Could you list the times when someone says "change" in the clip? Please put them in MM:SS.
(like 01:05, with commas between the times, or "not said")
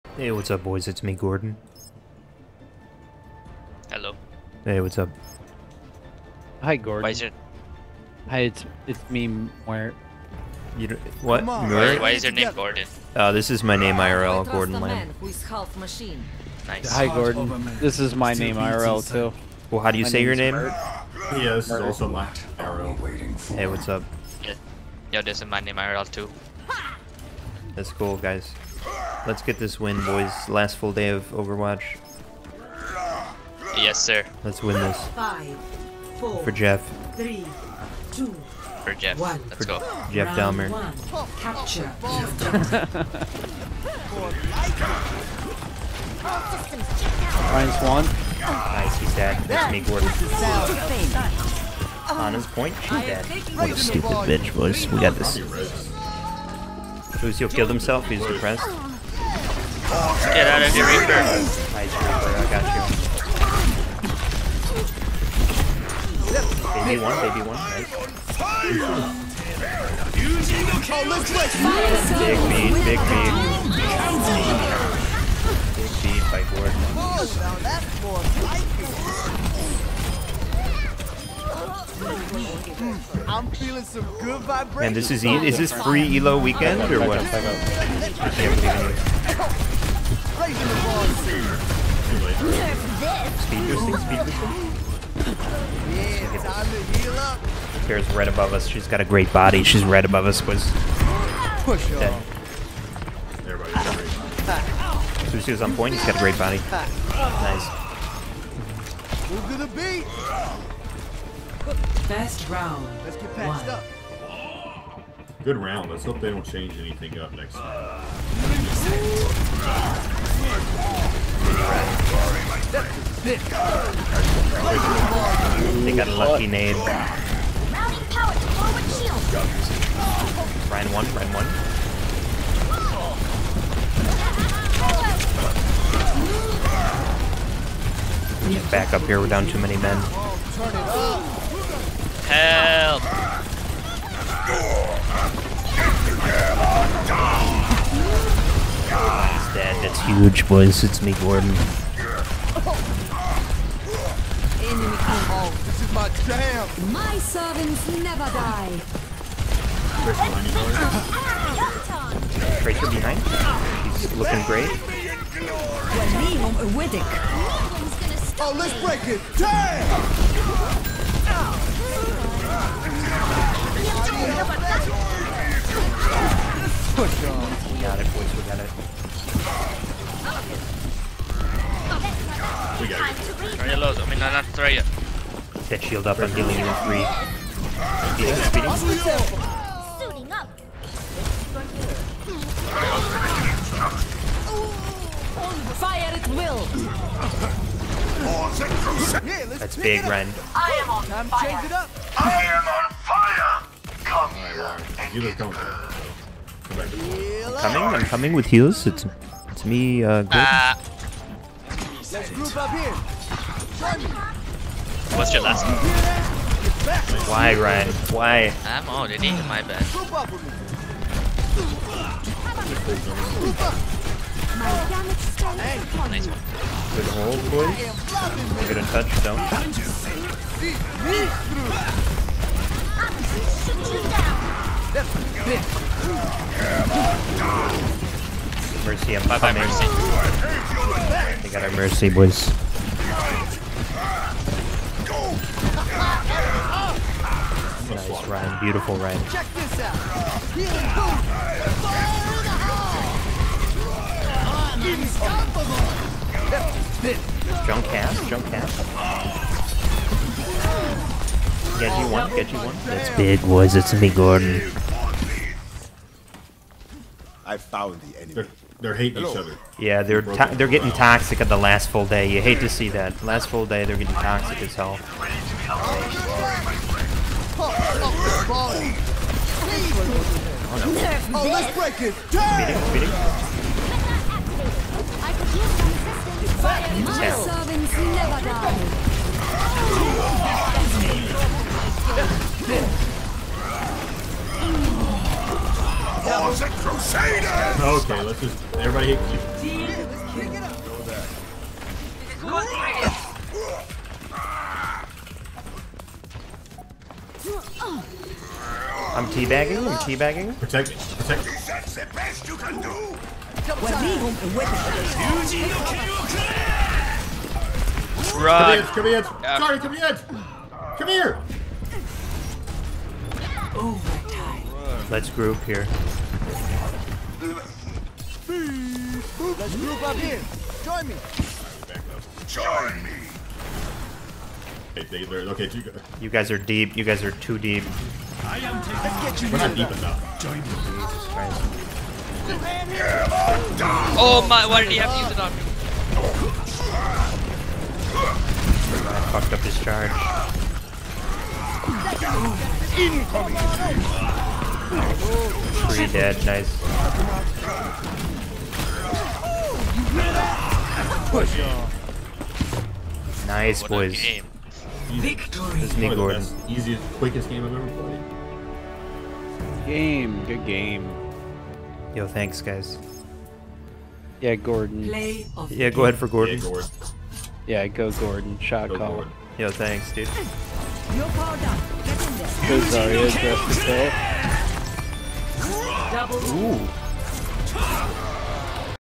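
01:56.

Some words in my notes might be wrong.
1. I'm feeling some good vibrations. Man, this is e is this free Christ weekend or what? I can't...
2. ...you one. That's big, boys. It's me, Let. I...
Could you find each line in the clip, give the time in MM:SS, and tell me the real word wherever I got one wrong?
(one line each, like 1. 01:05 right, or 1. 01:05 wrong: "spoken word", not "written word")
1. 01:23 wrong: "Elo", not "Christ"
2. 04:22 wrong: "Gordon", not "Let".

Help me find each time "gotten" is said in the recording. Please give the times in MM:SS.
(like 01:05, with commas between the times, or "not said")
not said.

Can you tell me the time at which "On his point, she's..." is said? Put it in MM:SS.
00:52.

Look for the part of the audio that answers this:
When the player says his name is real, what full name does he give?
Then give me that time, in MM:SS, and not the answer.
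00:14.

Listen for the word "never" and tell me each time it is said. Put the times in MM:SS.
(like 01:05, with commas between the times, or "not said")
02:37, 04:47.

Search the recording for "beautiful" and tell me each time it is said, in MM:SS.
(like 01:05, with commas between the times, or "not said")
04:08.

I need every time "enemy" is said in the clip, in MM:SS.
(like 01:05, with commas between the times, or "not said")
02:31, 04:28.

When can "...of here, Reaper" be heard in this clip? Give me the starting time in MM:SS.
01:00.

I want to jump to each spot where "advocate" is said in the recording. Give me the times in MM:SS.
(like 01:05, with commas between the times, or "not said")
not said.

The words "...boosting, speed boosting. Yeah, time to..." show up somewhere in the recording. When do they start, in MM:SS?
01:33.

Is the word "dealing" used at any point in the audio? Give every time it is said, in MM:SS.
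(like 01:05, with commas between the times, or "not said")
03:06.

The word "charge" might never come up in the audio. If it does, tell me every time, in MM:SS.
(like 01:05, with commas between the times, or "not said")
05:49.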